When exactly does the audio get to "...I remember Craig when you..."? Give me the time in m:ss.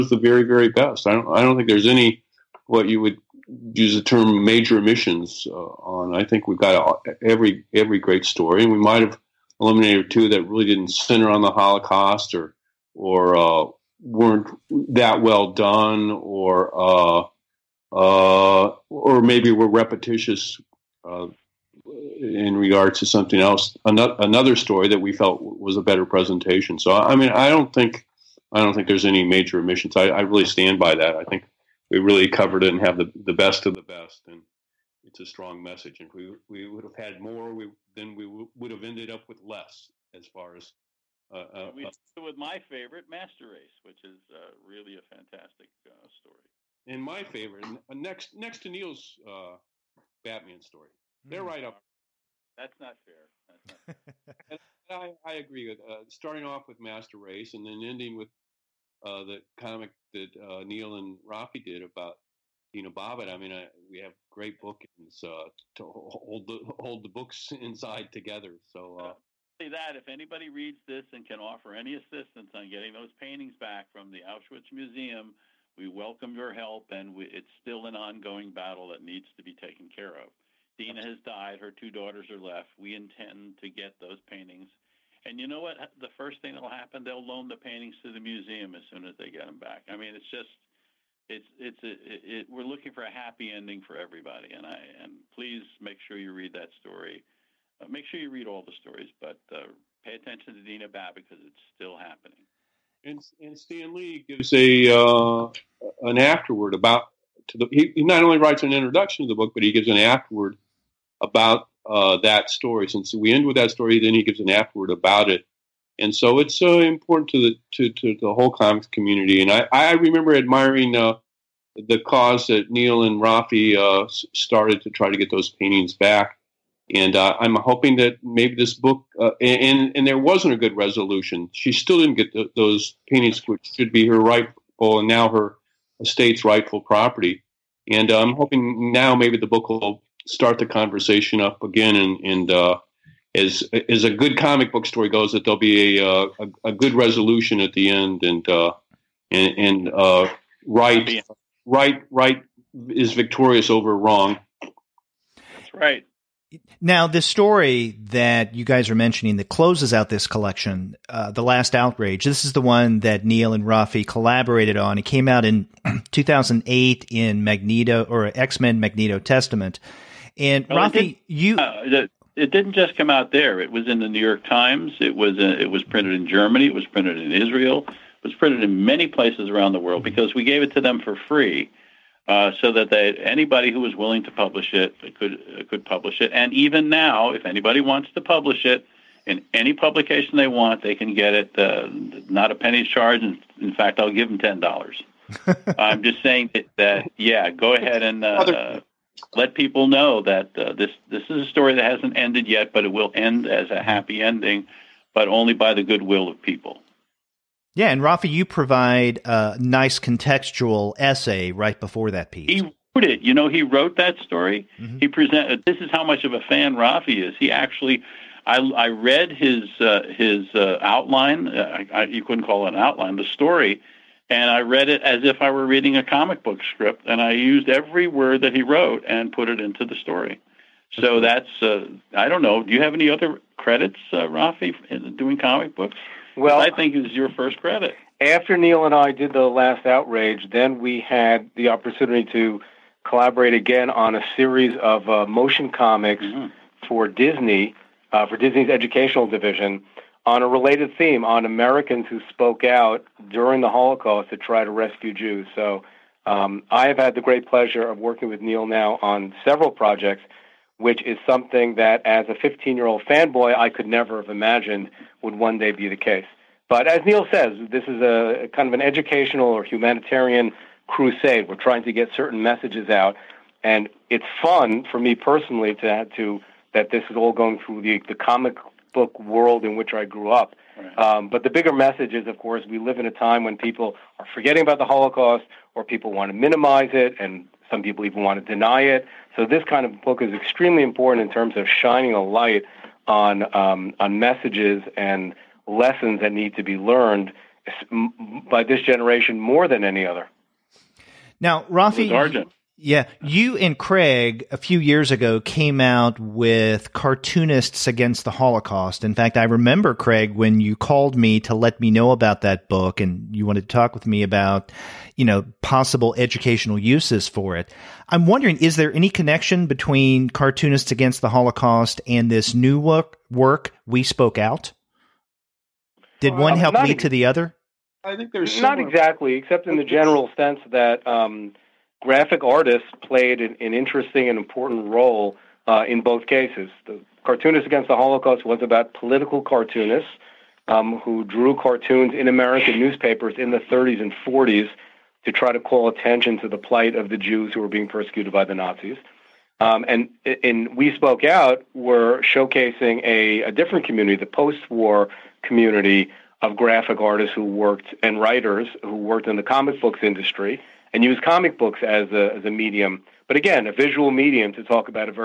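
5:09.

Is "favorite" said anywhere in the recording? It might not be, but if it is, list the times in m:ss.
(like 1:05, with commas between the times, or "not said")
0:42, 0:47.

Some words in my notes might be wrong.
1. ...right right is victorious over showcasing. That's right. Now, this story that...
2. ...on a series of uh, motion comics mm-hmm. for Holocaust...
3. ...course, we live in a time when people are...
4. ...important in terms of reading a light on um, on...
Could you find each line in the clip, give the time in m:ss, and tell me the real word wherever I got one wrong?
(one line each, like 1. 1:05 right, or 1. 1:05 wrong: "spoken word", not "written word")
1. 2:31 wrong: "wrong", not "showcasing"
2. 4:03 wrong: "Disney", not "Holocaust"
3. 4:42 right
4. 4:50 wrong: "shining", not "reading".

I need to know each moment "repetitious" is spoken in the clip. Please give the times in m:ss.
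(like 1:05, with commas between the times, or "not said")
0:19.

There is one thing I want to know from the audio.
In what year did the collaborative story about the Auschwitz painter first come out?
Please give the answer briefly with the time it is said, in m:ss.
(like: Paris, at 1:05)
2008, at 2:46.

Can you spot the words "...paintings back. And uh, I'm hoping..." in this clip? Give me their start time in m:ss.
2:05.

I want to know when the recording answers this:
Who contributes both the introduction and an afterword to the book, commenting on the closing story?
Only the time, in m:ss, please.
1:43.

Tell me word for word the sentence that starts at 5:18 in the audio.
I'm wondering is there any connection between Cartoonists Against the Holocaust and this new work, work We Spoke Out?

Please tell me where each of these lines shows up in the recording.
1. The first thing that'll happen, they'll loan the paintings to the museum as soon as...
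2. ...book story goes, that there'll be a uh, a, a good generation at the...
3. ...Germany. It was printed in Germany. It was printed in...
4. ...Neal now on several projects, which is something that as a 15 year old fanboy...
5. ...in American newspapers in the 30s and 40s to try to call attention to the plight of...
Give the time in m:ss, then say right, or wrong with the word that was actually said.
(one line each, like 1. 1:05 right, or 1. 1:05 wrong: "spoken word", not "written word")
1. 1:25 right
2. 2:24 wrong: "resolution", not "generation"
3. 2:56 wrong: "Israel", not "Germany"
4. 4:18 right
5. 5:42 right.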